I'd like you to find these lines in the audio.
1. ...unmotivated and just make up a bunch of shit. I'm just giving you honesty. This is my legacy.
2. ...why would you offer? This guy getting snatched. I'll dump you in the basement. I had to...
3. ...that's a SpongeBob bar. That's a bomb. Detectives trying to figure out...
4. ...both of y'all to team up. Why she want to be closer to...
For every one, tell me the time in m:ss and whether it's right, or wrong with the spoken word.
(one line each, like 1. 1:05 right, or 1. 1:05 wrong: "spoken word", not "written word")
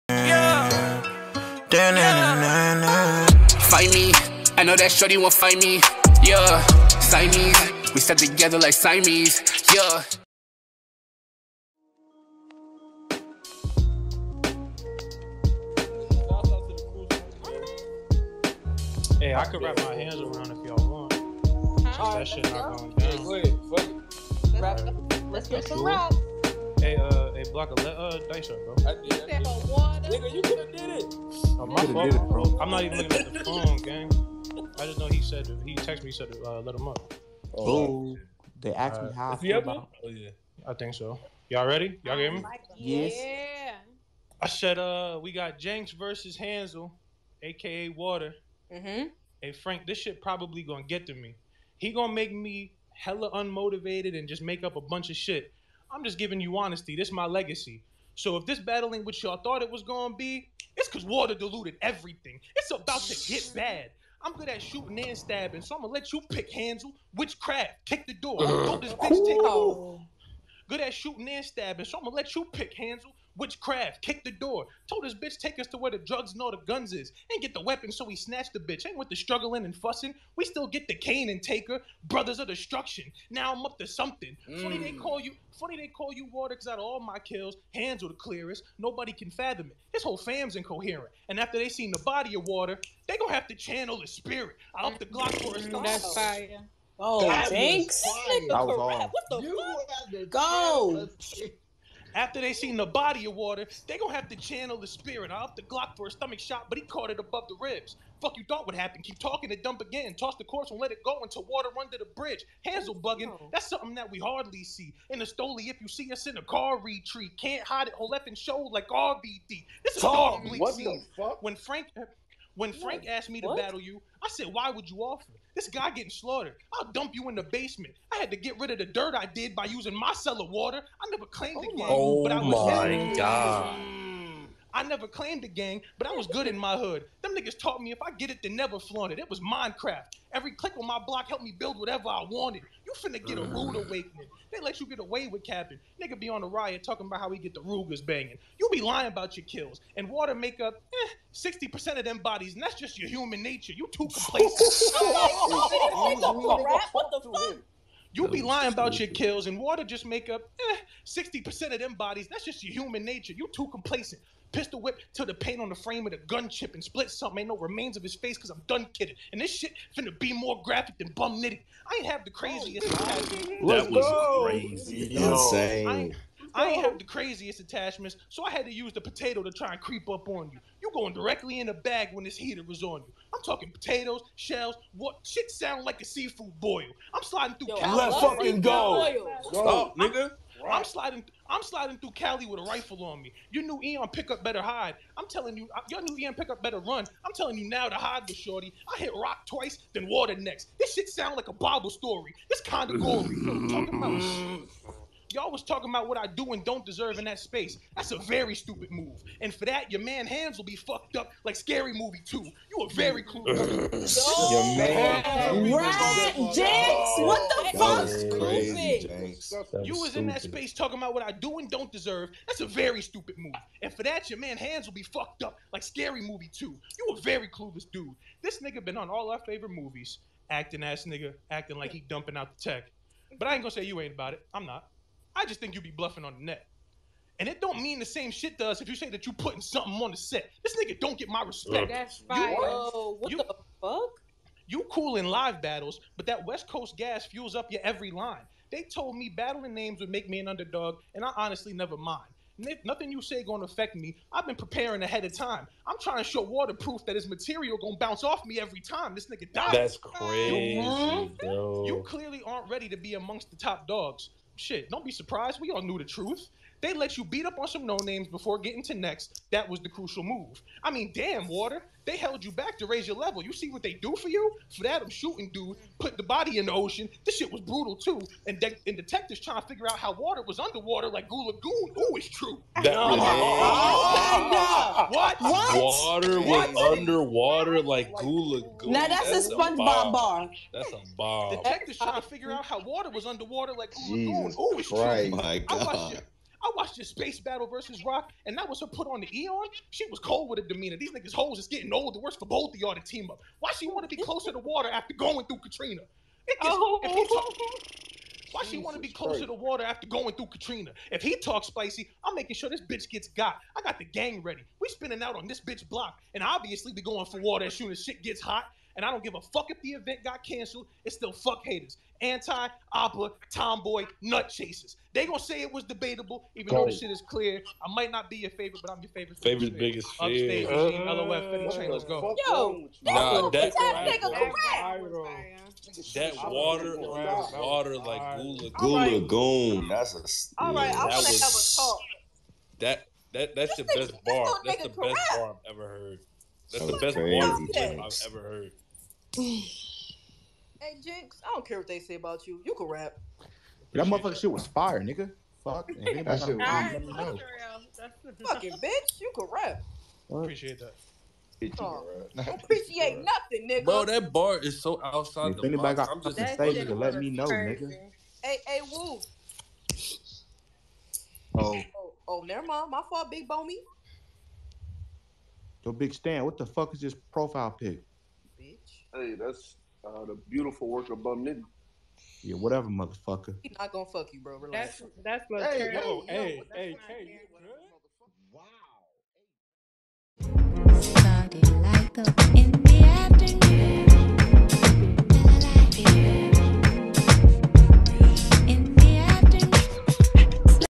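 1. 0:53 right
2. 2:04 wrong: "slaughtered", not "snatched"
3. 4:49 right
4. 5:02 right.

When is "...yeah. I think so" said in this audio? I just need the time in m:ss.
0:40.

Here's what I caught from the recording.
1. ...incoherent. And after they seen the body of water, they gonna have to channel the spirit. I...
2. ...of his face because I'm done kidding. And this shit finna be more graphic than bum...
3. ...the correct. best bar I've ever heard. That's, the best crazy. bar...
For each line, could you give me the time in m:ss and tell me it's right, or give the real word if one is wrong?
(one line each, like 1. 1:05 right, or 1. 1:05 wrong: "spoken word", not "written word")
1. 1:30 right
2. 2:47 right
3. 5:44 right.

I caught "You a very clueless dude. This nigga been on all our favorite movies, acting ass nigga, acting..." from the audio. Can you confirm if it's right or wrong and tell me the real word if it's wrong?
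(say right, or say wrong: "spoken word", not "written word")
right.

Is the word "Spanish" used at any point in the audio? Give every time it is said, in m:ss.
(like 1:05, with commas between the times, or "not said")
not said.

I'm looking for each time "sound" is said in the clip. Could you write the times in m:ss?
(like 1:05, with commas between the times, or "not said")
3:05, 3:21.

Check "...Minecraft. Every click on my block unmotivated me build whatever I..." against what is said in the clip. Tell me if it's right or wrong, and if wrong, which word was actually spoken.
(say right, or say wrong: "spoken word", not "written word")
wrong: "helped", not "unmotivated".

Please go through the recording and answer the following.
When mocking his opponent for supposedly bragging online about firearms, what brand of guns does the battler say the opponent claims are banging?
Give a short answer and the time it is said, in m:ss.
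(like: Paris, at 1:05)
Rugers, at 2:27.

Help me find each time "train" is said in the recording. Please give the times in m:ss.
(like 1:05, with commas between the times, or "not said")
5:31.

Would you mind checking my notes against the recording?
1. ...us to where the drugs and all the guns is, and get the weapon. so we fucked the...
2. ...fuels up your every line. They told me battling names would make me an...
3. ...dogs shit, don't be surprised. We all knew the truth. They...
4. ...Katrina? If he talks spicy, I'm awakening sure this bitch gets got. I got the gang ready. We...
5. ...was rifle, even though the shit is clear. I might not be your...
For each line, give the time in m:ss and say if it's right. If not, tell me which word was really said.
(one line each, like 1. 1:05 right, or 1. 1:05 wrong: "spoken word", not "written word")
1. 1:15 wrong: "snatched", not "fucked"
2. 4:07 right
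3. 4:23 right
4. 5:10 wrong: "making", not "awakening"
5. 5:25 wrong: "debatable", not "rifle".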